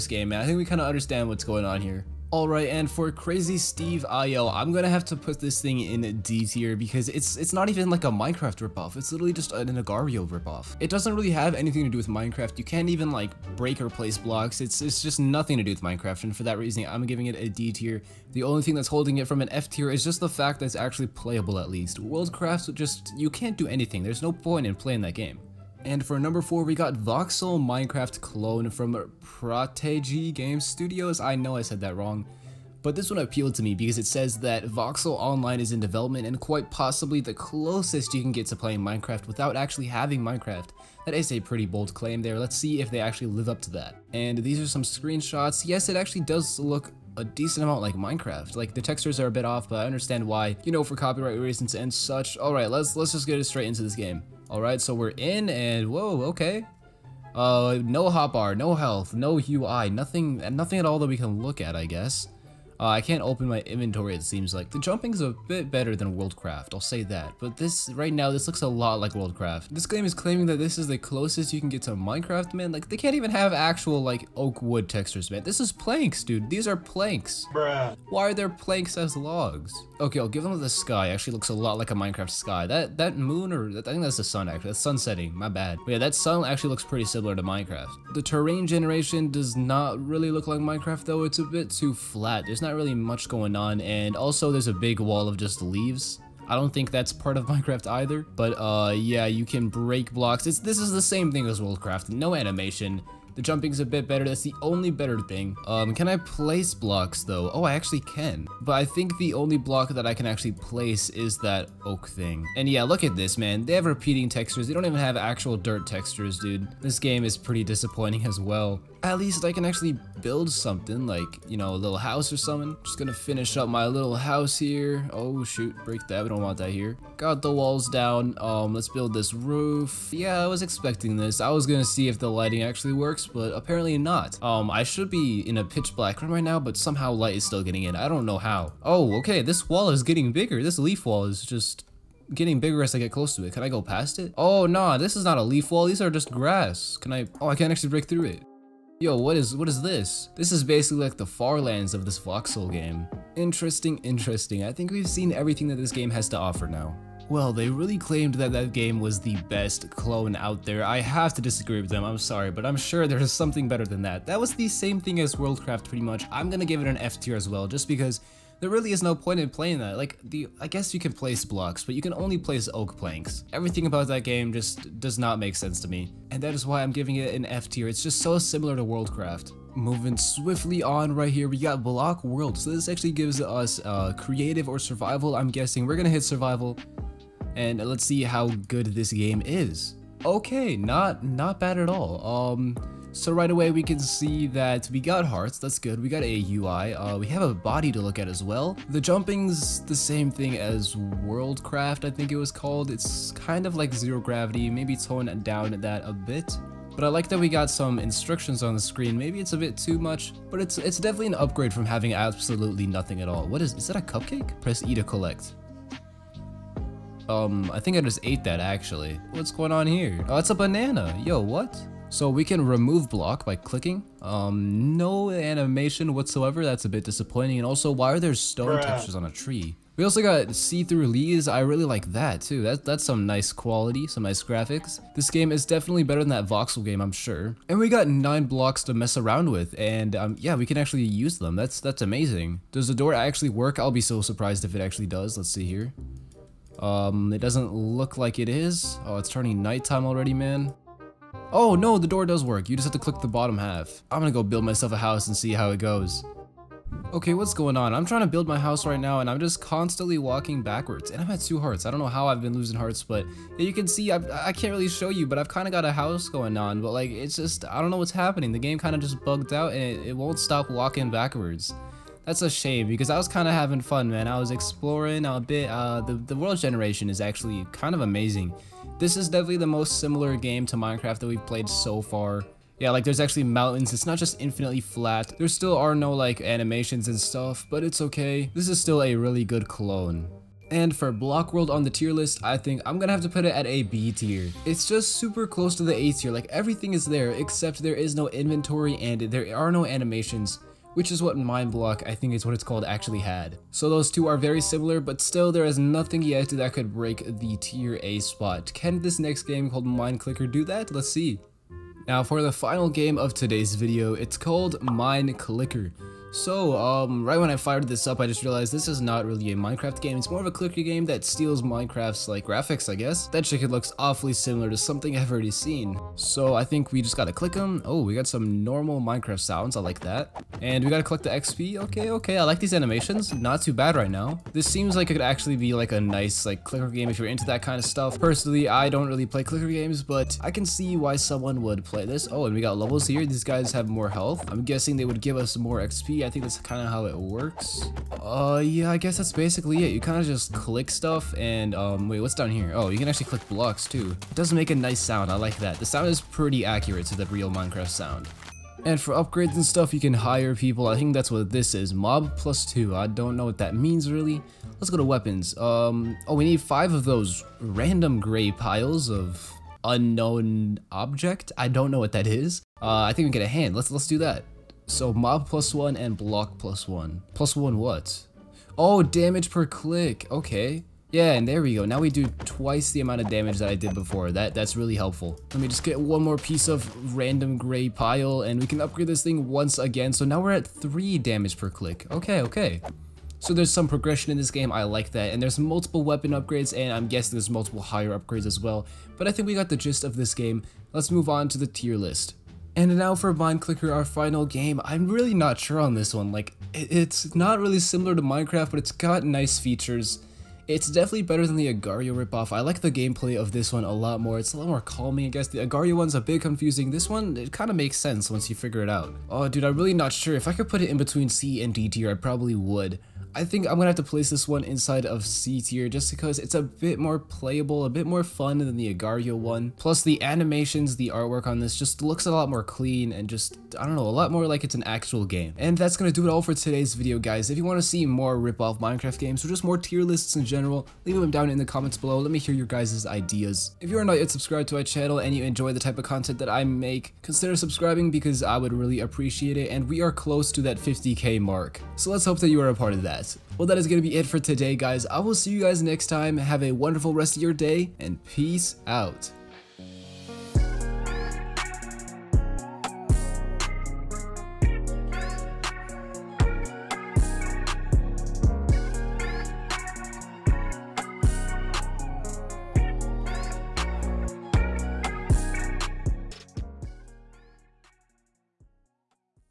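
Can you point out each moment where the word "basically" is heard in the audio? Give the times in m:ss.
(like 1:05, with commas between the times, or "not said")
2:30, 5:49.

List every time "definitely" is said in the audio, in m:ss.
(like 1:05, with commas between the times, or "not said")
3:30, 3:55, 4:39, 6:50.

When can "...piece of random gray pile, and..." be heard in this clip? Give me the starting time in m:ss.
6:26.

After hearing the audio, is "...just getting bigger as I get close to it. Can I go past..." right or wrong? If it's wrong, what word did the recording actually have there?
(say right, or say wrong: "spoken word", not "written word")
right.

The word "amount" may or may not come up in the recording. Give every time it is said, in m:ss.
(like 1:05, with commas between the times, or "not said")
0:47, 6:22.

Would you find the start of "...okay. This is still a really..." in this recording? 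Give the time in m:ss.
4:47.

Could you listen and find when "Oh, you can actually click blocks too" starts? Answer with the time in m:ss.
5:52.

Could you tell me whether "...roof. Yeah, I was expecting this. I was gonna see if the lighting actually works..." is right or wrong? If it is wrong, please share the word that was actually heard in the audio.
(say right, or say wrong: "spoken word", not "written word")
right.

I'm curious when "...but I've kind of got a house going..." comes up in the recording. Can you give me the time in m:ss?
4:25.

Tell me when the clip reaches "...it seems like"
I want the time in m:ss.
1:04.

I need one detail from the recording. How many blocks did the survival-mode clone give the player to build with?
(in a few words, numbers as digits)
9.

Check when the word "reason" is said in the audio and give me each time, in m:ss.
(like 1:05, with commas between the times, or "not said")
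0:16, 0:51.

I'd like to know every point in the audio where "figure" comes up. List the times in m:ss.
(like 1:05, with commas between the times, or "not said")
6:58.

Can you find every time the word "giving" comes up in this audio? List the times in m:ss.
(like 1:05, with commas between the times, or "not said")
0:17, 2:56.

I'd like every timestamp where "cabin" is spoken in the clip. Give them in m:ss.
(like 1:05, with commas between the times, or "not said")
not said.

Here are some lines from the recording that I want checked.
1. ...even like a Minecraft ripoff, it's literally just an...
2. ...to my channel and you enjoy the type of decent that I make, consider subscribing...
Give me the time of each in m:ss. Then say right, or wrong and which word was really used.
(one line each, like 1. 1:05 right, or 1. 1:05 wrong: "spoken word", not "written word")
1. 0:07 right
2. 7:24 wrong: "content", not "decent".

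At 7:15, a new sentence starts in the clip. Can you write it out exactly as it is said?
And that's gonna do it all for today's video guys.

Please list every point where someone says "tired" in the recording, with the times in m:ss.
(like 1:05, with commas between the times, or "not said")
not said.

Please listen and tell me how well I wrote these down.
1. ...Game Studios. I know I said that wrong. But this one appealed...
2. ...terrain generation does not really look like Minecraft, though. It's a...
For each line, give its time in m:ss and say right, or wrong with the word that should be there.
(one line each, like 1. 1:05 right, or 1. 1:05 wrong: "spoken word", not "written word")
1. 0:30 right
2. 1:28 right.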